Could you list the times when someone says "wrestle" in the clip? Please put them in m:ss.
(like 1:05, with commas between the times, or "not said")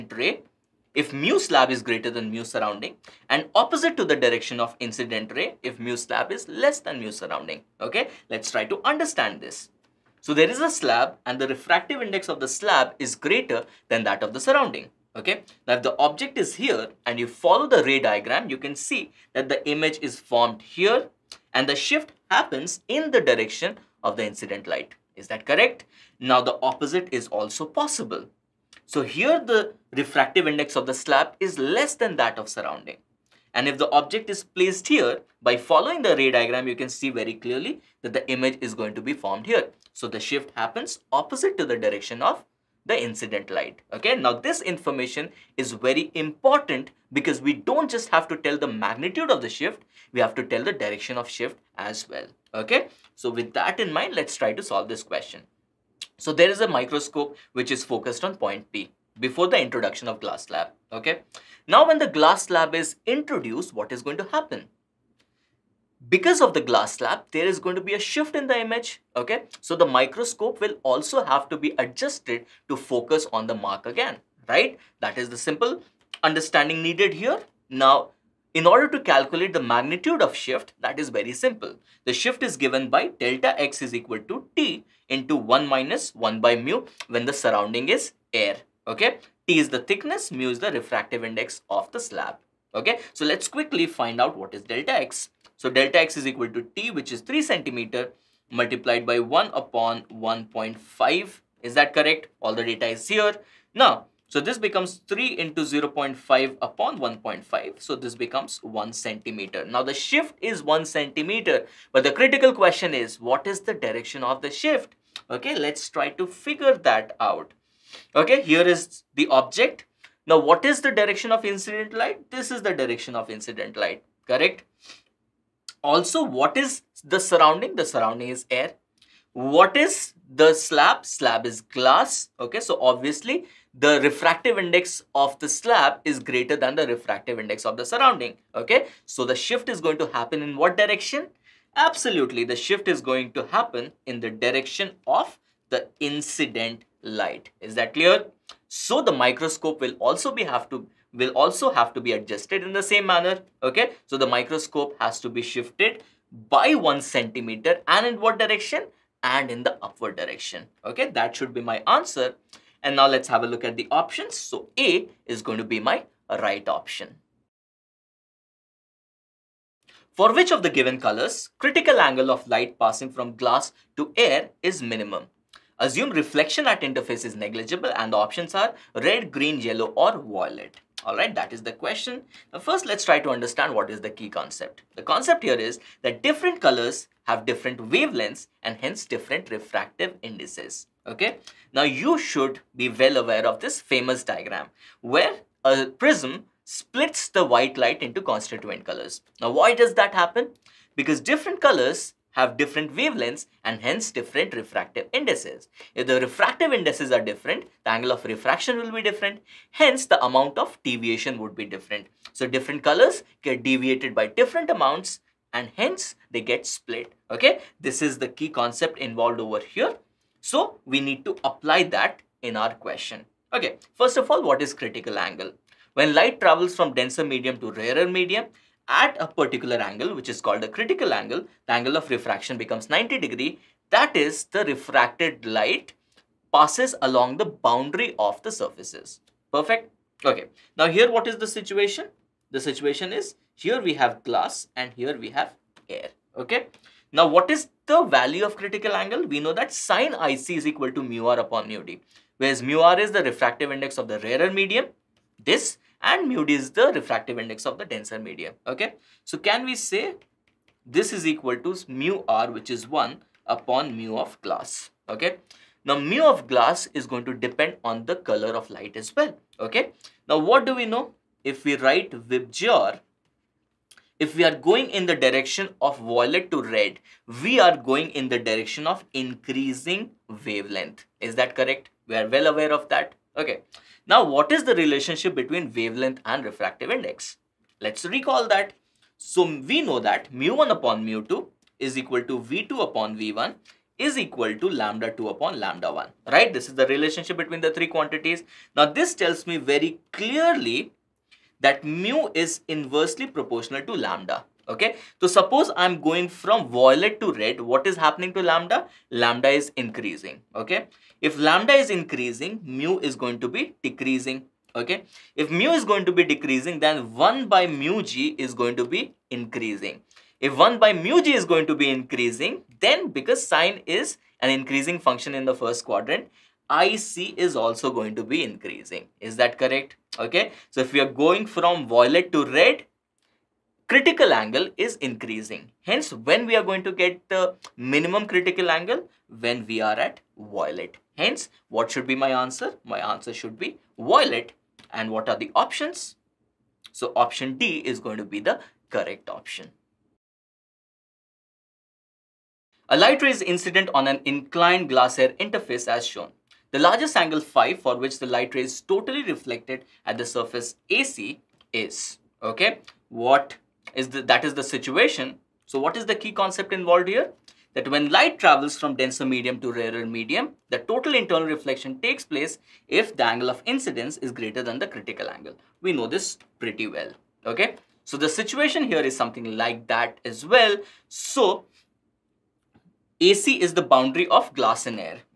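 not said.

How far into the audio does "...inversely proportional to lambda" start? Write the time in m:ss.
5:02.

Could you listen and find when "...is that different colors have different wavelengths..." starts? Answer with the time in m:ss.
3:05.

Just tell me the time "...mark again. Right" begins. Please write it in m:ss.
1:13.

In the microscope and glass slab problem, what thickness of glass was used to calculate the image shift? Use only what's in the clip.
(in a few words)
3 cm.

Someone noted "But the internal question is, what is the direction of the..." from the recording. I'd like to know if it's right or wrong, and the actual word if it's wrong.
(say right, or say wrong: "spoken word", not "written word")
wrong: "critical", not "internal".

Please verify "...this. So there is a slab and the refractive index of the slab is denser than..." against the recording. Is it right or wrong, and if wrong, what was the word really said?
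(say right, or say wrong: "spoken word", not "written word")
wrong: "greater", not "denser".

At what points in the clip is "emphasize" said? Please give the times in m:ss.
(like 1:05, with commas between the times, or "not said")
not said.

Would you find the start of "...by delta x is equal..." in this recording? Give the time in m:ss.
1:22.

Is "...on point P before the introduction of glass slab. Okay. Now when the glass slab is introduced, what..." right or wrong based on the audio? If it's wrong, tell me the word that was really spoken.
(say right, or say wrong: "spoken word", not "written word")
right.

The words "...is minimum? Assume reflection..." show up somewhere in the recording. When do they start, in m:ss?
2:54.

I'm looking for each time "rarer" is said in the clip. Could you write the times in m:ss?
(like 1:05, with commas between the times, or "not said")
3:47, 4:14, 6:09.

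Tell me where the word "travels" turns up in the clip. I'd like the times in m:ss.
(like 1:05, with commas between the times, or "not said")
3:46, 6:08.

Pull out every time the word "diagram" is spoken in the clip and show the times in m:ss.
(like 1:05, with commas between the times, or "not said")
0:17, 0:36, 3:14.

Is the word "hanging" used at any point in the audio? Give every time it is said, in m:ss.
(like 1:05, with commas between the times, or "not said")
not said.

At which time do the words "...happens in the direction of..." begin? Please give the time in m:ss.
0:22.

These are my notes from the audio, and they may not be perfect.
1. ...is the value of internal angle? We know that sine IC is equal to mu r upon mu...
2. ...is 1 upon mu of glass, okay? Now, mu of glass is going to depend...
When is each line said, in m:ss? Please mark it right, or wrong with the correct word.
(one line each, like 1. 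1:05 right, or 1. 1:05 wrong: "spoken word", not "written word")
1. 4:07 wrong: "critical", not "internal"
2. 4:22 right.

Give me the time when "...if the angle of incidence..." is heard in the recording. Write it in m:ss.
6:12.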